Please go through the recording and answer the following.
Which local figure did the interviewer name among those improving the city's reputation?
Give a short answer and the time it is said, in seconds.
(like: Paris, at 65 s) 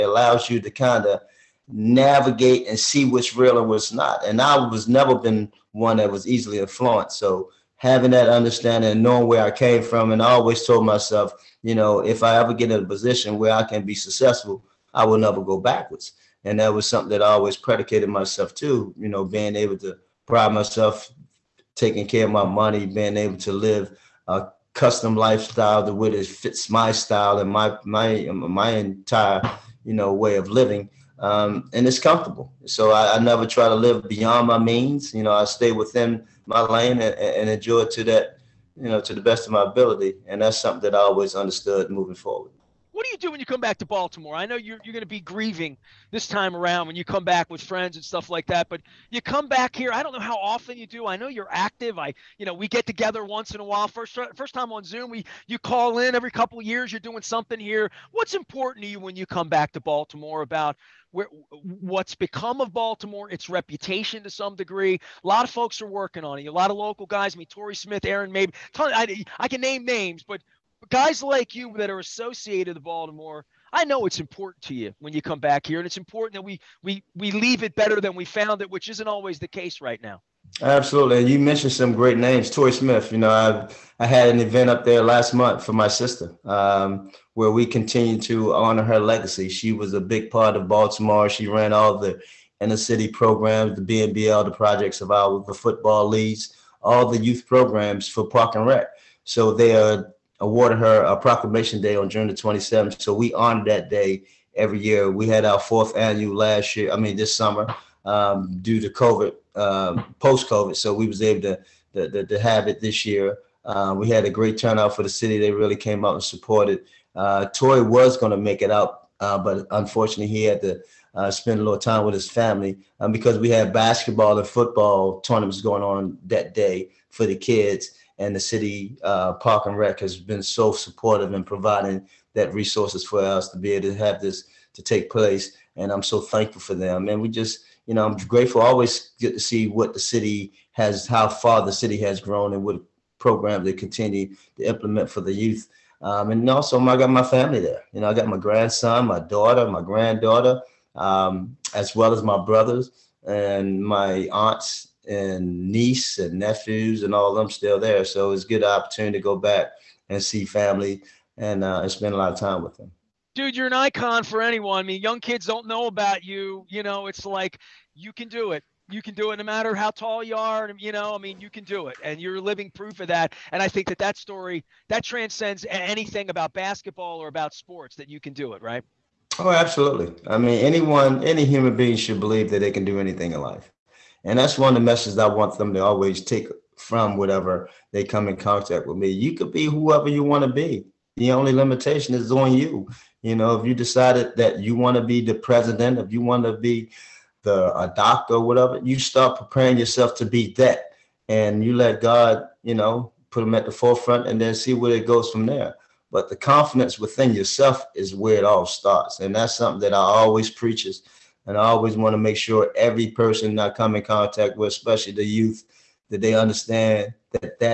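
Torrey Smith, at 82 s.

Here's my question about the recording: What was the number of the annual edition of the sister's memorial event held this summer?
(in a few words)
4th.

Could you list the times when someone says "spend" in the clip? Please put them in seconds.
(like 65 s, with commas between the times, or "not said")
121 s, 161 s.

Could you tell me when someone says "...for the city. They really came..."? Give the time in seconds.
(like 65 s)
114 s.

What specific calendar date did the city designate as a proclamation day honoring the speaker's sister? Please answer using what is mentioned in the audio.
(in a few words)
June 27.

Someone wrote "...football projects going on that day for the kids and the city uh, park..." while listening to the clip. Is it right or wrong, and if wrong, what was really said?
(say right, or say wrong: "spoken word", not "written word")
wrong: "tournaments", not "projects".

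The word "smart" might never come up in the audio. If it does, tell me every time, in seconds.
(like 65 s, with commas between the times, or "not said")
not said.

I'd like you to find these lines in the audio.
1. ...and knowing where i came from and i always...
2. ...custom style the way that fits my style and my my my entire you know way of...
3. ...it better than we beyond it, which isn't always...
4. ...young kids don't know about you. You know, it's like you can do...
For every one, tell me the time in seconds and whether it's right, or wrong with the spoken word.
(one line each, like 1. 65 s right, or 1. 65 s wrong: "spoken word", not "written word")
1. 8 s right
2. 24 s wrong: "lifestyle", not "style"
3. 77 s wrong: "found", not "beyond"
4. 165 s right.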